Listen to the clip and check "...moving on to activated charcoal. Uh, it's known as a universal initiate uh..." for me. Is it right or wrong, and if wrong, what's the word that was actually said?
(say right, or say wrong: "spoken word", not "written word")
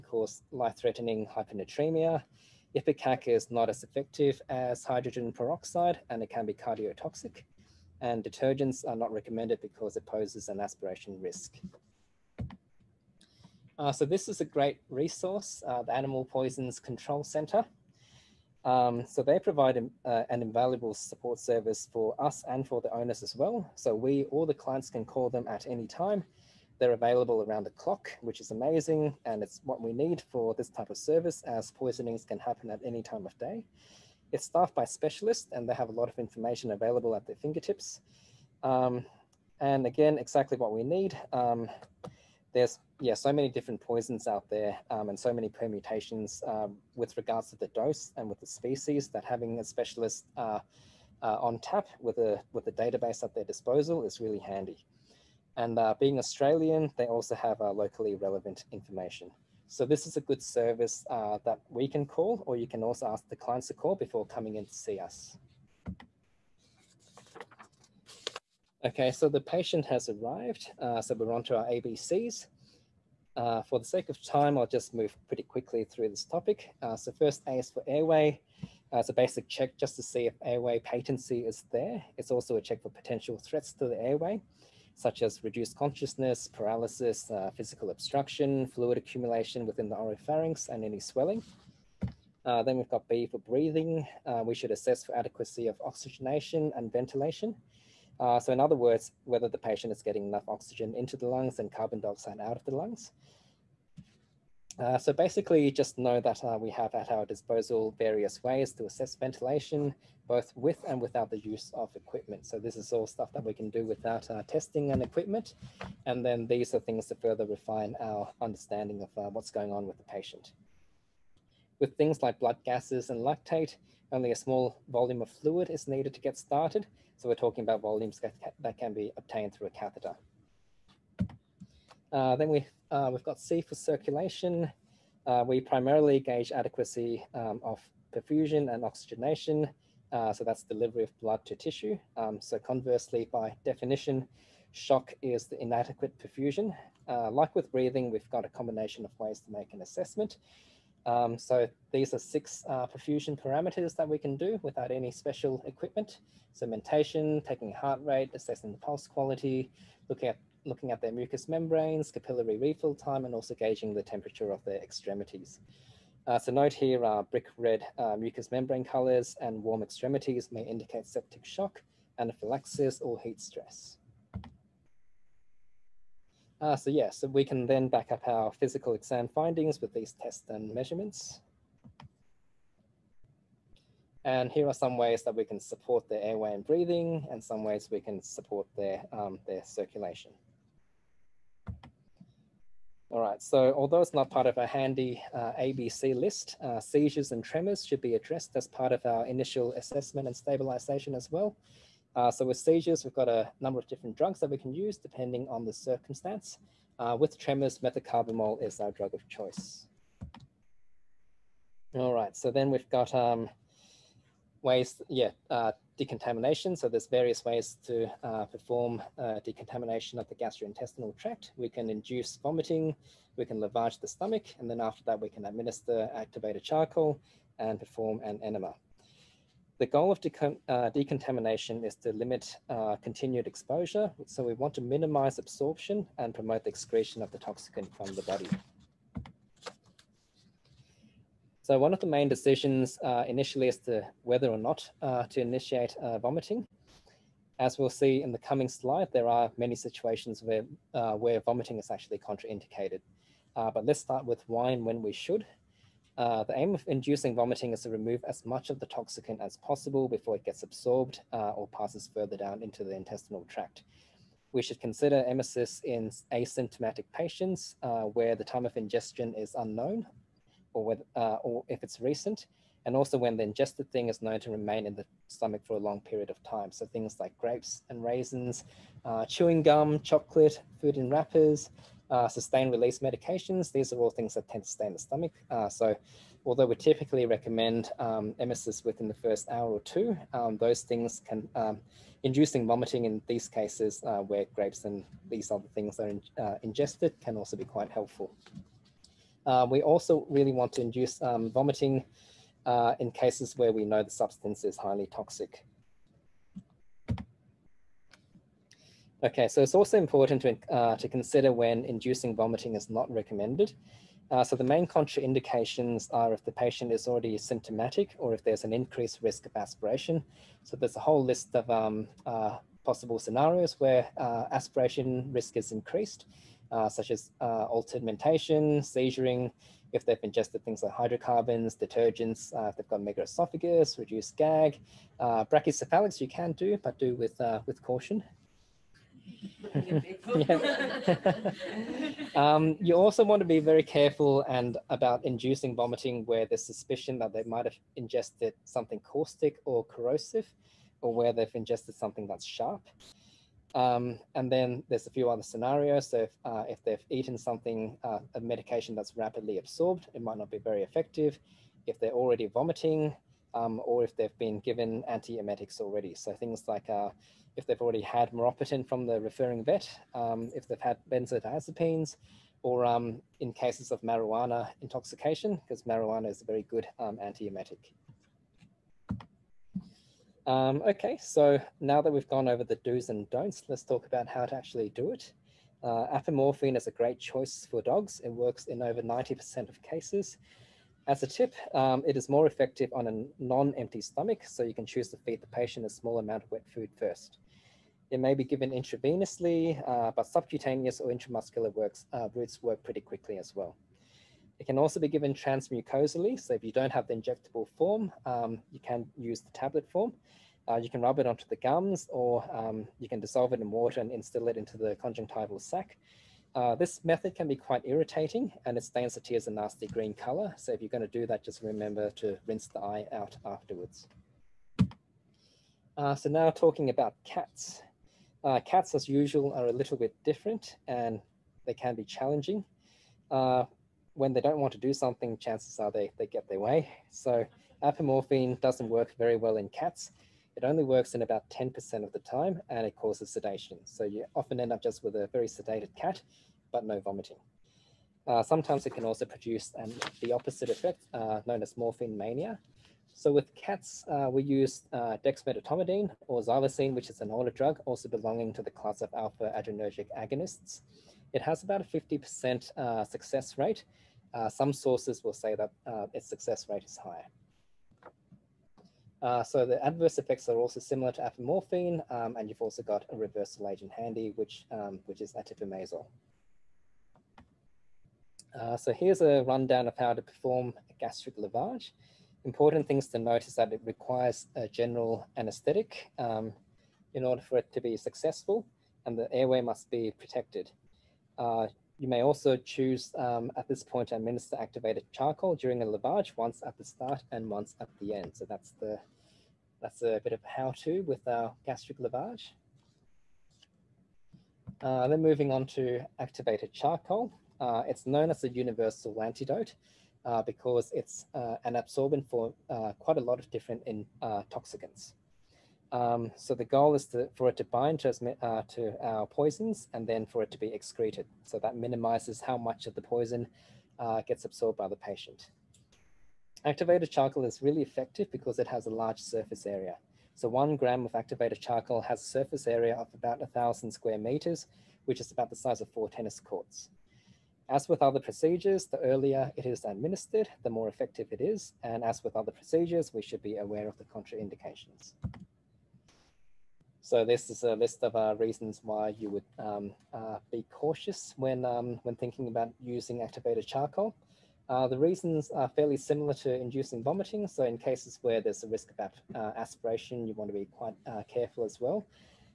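wrong: "antidote", not "initiate".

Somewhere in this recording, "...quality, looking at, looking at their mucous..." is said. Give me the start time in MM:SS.
02:39.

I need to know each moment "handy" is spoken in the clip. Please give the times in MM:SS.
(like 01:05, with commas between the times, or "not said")
00:54, 03:14, 07:53.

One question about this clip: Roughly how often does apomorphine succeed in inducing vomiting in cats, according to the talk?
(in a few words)
10%.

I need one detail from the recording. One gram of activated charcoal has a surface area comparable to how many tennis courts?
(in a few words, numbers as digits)
4.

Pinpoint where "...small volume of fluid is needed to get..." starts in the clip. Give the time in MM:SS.
02:04.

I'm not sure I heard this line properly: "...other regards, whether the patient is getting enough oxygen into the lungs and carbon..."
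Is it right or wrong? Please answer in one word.
wrong.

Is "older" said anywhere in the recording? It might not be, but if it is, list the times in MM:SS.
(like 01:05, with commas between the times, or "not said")
07:37.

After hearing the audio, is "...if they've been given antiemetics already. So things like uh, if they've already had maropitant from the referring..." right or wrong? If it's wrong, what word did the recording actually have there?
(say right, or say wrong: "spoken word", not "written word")
right.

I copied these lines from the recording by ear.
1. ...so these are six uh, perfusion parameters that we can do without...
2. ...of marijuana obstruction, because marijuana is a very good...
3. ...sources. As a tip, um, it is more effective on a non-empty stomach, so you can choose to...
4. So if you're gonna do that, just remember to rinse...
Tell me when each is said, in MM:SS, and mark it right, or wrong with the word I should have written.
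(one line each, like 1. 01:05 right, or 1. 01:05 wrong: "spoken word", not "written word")
1. 02:31 right
2. 06:13 wrong: "intoxication", not "obstruction"
3. 06:29 wrong: "cases", not "sources"
4. 07:00 right.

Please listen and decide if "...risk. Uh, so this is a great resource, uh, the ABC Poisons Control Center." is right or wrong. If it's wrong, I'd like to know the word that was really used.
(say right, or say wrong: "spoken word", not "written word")
wrong: "Animal", not "ABC".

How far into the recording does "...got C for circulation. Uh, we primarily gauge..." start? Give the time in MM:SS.
02:13.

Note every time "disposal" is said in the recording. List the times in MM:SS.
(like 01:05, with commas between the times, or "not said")
00:53, 01:47.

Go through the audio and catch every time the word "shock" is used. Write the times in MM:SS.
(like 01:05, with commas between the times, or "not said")
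02:24, 02:51.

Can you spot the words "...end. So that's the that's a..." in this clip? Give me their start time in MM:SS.
08:18.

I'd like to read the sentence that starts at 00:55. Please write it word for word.
And uh, being Australian, they also have uh, locally relevant information.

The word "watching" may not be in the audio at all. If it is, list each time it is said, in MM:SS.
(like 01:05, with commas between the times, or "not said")
not said.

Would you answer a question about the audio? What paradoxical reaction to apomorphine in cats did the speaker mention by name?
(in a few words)
Morphine mania.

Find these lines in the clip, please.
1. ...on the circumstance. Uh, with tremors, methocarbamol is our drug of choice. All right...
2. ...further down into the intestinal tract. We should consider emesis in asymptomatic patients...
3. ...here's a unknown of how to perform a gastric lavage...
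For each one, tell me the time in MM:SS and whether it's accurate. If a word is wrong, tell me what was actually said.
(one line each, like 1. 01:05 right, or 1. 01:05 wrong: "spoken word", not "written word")
1. 03:25 right
2. 04:22 right
3. 07:58 wrong: "rundown", not "unknown".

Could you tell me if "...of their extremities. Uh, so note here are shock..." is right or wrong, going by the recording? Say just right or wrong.
wrong.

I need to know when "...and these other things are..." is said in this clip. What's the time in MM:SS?
04:54.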